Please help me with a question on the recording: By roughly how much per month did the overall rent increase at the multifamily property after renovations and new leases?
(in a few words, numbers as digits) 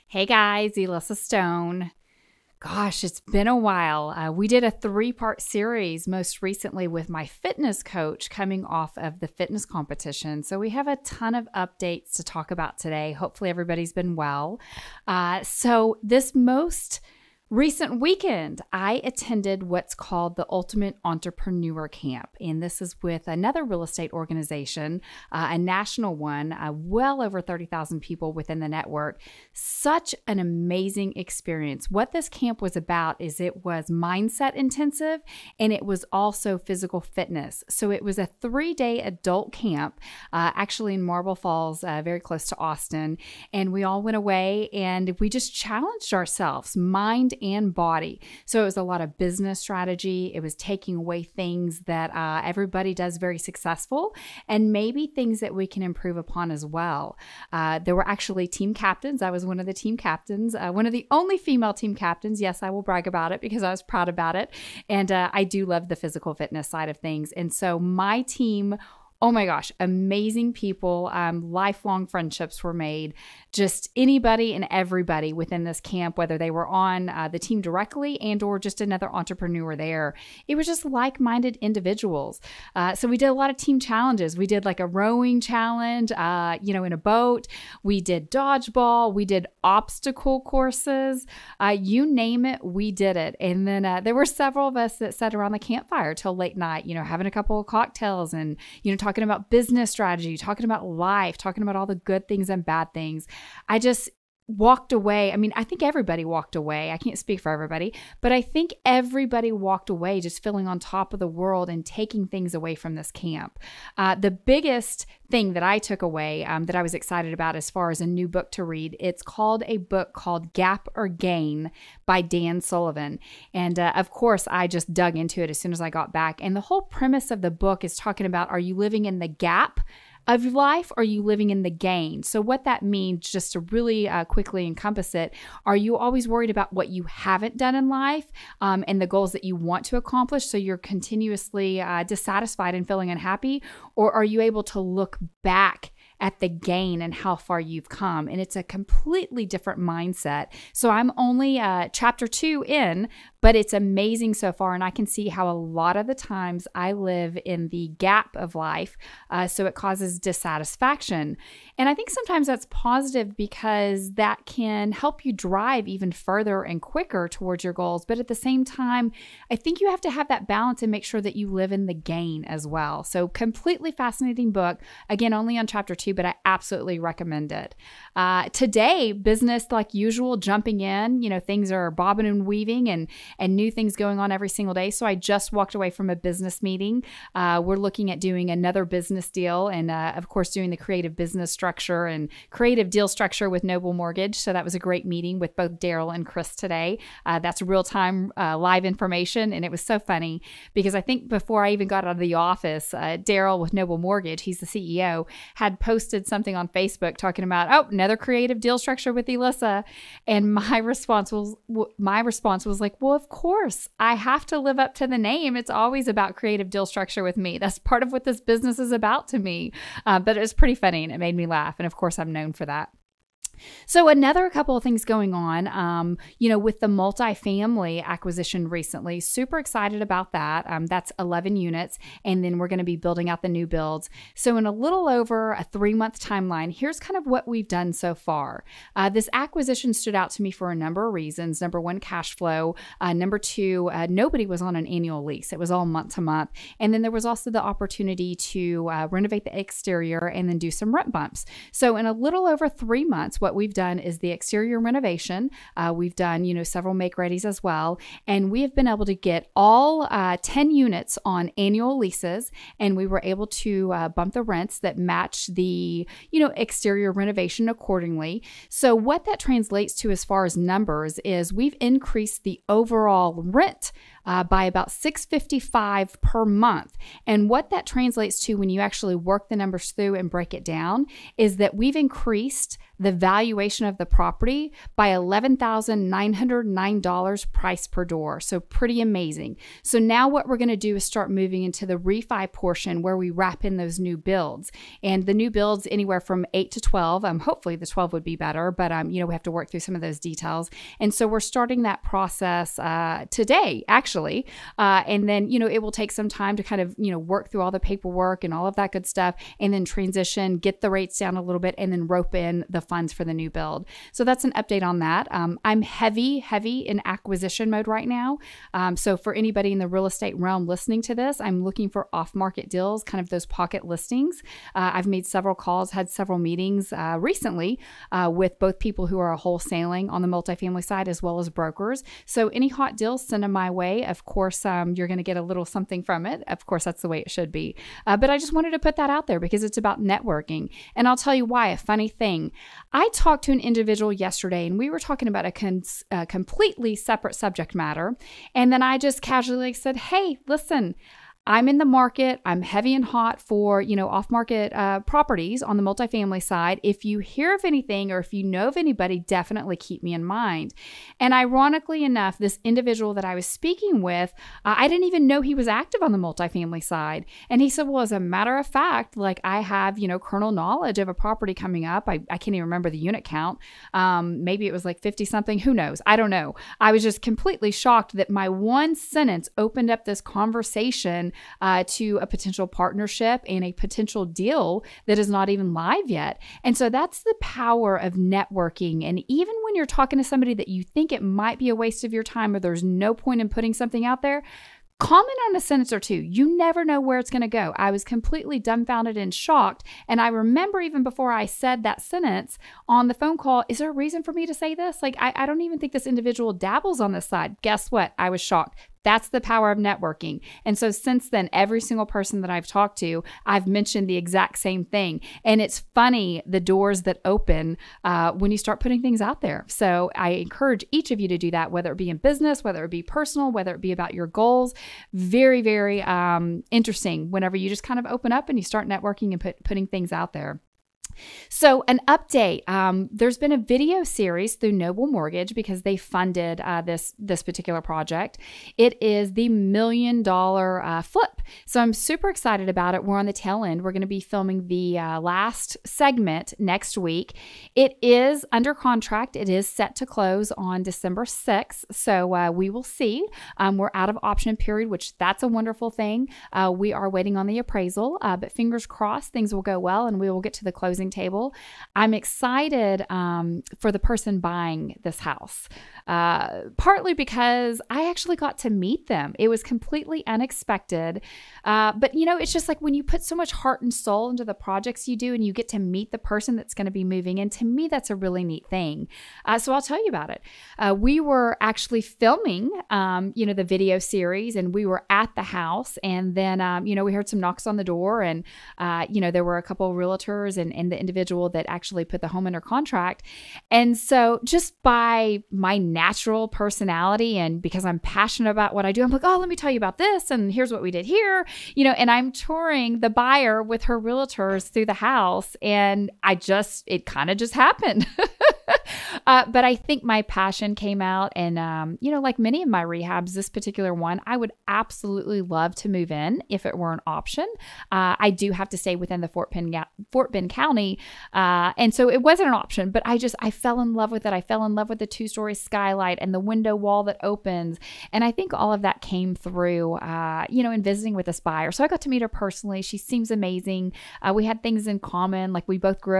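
655.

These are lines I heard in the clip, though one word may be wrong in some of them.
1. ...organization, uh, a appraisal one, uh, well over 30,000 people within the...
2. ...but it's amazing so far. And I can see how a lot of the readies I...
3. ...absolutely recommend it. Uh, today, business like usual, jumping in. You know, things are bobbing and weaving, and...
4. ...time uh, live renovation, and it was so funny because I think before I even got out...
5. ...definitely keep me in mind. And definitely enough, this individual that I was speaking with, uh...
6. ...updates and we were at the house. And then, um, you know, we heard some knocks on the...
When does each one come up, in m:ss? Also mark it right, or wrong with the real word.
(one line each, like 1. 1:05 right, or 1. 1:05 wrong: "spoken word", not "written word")
1. 0:24 wrong: "national", not "appraisal"
2. 2:33 wrong: "times", not "readies"
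3. 2:56 right
4. 3:17 wrong: "information", not "renovation"
5. 5:59 wrong: "ironically", not "definitely"
6. 8:03 wrong: "series", not "updates".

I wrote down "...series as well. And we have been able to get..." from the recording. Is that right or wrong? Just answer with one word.
wrong.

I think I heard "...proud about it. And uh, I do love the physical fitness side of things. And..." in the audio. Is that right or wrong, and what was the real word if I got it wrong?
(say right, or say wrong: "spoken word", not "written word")
right.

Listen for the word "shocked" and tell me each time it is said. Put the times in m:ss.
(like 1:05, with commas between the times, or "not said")
6:17, 6:39, 6:48.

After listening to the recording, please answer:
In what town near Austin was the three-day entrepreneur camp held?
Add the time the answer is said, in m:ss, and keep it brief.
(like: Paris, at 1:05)
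Marble Falls, at 0:41.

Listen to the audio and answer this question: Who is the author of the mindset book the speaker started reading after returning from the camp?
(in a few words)
Dan Sullivan.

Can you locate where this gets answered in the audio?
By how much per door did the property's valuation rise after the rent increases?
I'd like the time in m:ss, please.
4:45.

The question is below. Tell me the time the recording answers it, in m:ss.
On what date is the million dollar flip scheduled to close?
7:30.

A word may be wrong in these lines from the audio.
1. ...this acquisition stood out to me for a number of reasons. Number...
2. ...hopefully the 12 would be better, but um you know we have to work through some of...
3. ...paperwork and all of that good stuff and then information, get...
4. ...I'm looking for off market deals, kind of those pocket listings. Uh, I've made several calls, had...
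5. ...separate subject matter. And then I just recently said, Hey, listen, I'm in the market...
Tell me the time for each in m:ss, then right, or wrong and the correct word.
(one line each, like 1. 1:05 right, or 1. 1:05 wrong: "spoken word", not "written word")
1. 3:59 right
2. 4:57 right
3. 5:07 wrong: "transition", not "information"
4. 5:21 right
5. 5:46 wrong: "casually", not "recently".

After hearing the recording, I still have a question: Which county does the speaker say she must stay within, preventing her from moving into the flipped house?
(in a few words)
Fort Bend County.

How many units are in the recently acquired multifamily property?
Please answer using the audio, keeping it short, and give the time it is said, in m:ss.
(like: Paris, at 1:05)
11, at 3:51.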